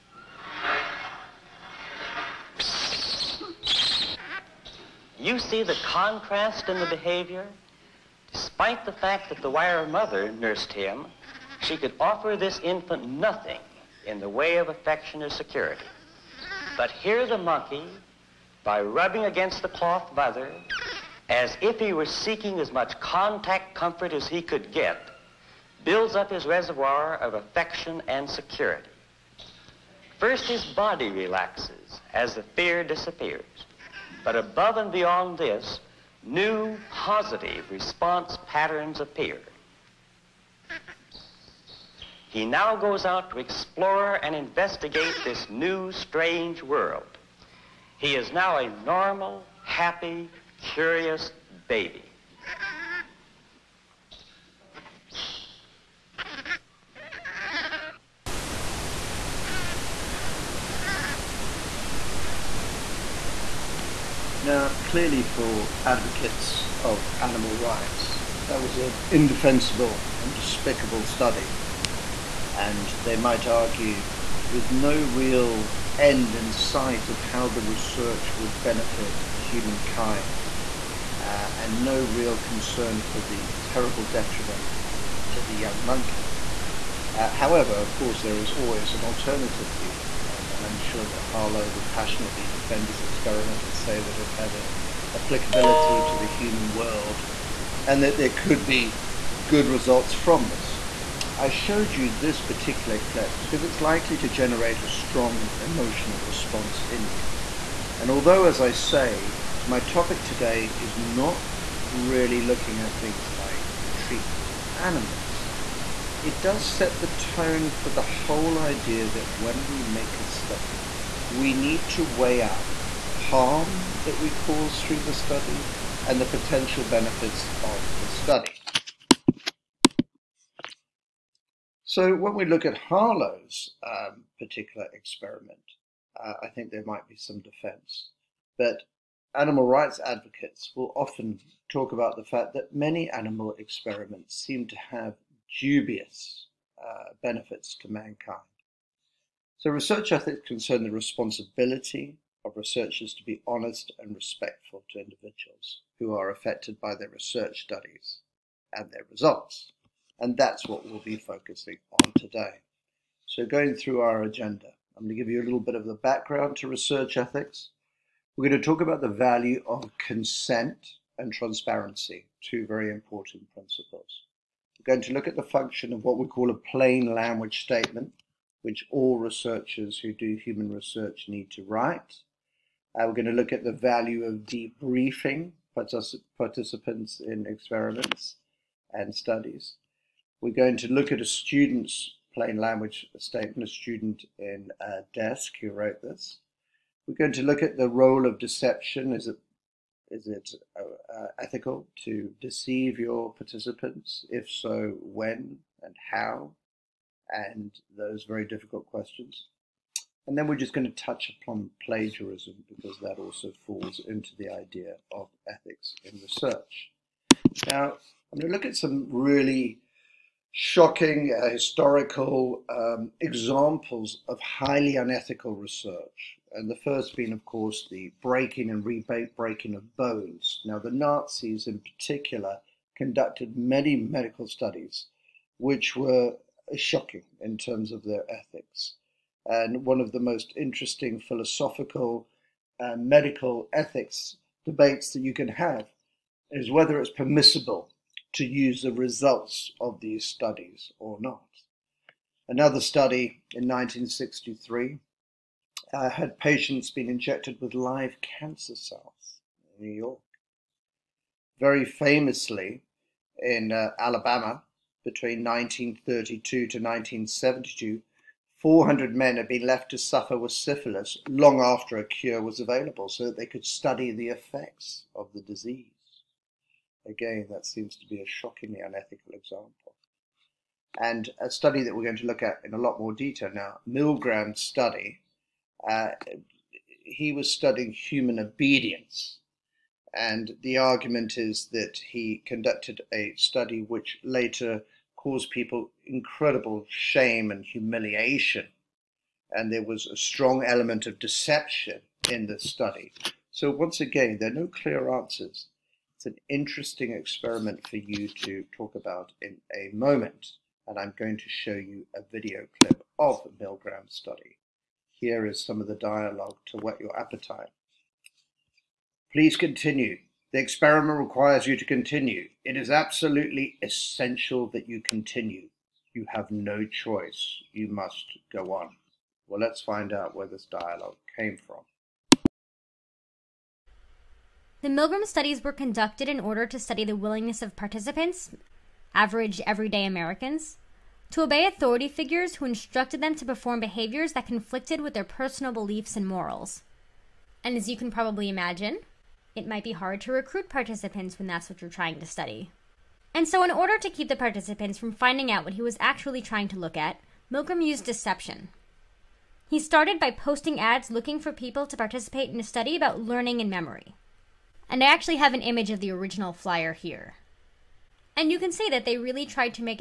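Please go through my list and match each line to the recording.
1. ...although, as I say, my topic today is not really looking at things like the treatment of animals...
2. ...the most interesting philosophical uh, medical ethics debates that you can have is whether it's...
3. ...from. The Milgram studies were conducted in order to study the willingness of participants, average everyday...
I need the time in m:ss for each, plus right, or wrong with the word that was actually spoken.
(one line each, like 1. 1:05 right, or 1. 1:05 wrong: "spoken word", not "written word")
1. 1:48 right
2. 4:00 right
3. 5:31 right.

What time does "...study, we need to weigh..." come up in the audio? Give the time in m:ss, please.
2:00.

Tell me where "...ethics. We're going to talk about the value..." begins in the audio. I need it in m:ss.
2:47.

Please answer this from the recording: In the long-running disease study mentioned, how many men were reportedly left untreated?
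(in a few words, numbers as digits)
400.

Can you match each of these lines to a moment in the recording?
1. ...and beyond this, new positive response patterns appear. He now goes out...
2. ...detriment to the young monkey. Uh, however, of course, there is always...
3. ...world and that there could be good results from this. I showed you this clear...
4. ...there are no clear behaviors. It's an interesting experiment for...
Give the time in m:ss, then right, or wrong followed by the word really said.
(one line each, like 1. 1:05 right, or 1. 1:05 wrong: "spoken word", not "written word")
1. 0:34 right
2. 1:24 right
3. 1:36 wrong: "particular", not "clear"
4. 5:04 wrong: "answers", not "behaviors".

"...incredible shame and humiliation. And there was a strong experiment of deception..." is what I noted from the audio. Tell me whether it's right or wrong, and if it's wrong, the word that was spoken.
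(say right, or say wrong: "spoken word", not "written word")
wrong: "element", not "experiment".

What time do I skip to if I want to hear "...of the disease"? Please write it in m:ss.
4:35.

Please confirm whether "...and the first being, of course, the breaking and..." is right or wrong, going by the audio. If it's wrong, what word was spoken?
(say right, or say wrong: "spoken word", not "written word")
right.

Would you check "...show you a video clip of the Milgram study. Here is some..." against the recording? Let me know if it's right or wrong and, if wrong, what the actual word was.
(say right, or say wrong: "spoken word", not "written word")
right.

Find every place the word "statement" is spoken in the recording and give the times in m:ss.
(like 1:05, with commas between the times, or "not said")
2:57, 3:13.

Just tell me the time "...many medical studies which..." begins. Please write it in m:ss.
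3:53.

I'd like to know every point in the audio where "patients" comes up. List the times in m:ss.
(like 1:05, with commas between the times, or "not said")
4:16.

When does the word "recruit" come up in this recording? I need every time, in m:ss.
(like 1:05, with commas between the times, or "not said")
5:50.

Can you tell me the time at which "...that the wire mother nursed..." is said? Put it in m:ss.
0:09.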